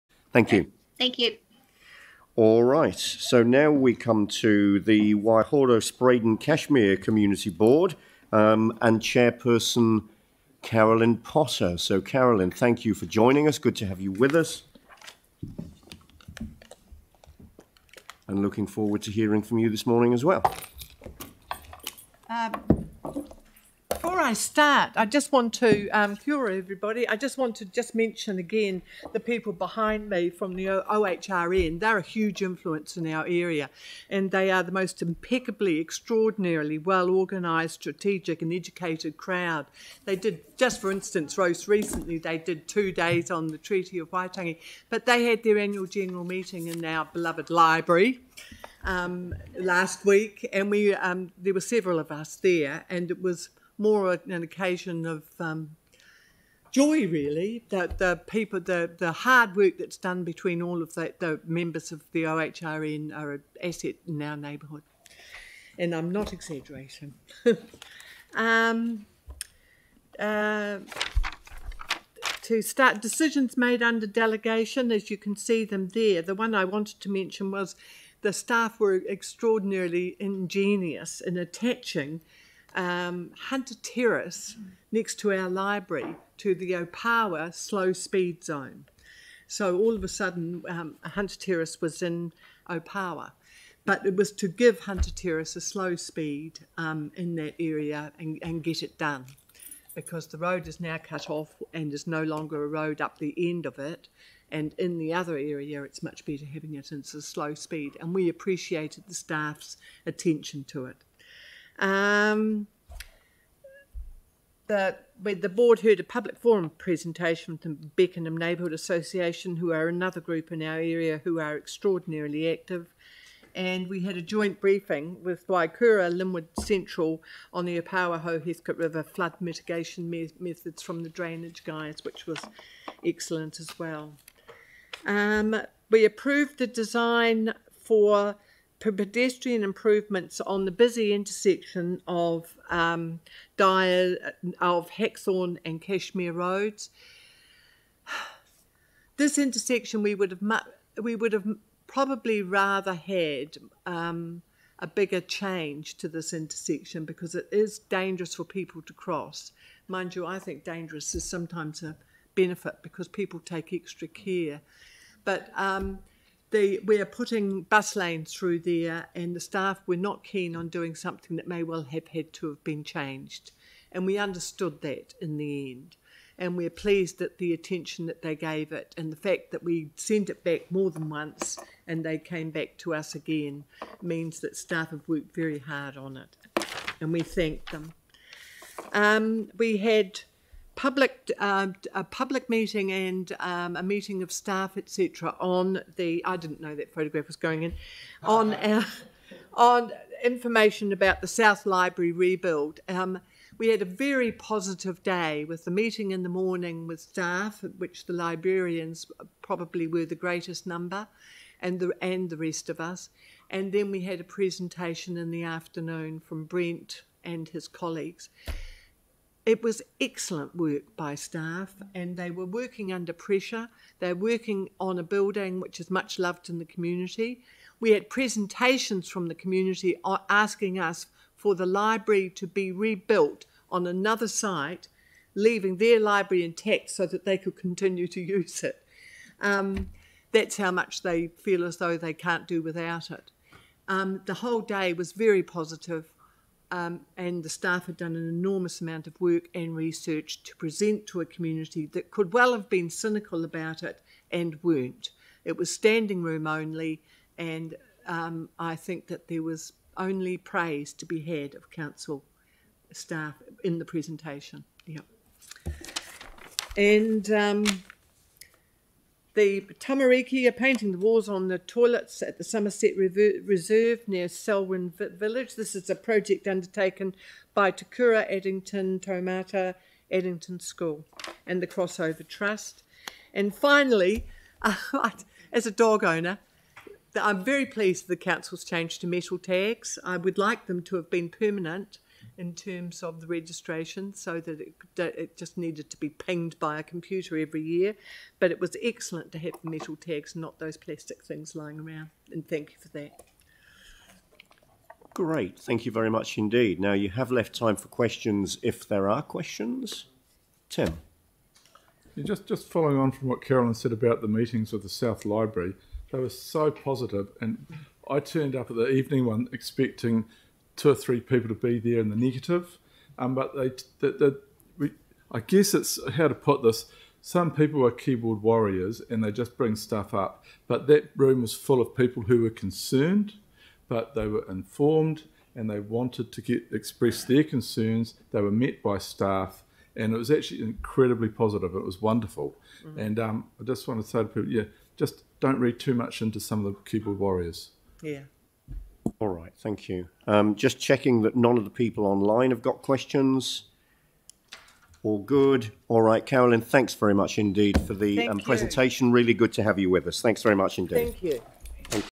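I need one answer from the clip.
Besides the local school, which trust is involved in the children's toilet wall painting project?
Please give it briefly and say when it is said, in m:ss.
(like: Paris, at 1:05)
Crossover Trust, at 4:41.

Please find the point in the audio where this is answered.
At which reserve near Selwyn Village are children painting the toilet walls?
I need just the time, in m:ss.
4:32.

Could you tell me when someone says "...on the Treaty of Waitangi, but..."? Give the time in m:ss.
0:43.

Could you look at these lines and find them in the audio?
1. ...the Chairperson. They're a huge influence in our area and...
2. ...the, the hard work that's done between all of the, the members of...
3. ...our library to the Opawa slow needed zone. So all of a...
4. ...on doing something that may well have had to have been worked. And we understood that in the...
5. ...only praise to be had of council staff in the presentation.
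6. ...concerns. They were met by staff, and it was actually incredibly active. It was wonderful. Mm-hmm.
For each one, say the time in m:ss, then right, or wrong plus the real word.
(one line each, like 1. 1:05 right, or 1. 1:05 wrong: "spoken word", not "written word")
1. 0:30 wrong: "OHRN", not "Chairperson"
2. 0:58 right
3. 1:25 wrong: "speed", not "needed"
4. 2:50 wrong: "changed", not "worked"
5. 4:19 right
6. 5:37 wrong: "positive", not "active".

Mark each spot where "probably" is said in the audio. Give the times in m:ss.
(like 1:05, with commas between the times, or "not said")
2:31, 3:29.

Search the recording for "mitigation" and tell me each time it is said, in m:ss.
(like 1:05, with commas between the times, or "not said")
2:09.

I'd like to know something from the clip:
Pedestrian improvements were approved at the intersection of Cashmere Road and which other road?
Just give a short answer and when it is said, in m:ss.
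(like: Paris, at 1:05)
Hackthorne, at 2:24.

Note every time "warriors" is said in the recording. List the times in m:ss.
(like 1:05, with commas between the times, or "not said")
5:28, 5:47.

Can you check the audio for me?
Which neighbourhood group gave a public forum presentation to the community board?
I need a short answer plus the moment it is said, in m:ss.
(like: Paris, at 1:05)
Beckenham Neighbourhood Association, at 1:57.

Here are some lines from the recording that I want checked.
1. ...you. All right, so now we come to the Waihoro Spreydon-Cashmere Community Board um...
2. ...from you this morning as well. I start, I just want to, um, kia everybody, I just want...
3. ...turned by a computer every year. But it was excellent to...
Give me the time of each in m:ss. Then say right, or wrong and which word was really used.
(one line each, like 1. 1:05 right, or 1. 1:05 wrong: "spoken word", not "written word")
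1. 0:01 right
2. 0:19 right
3. 4:56 wrong: "pinged", not "turned".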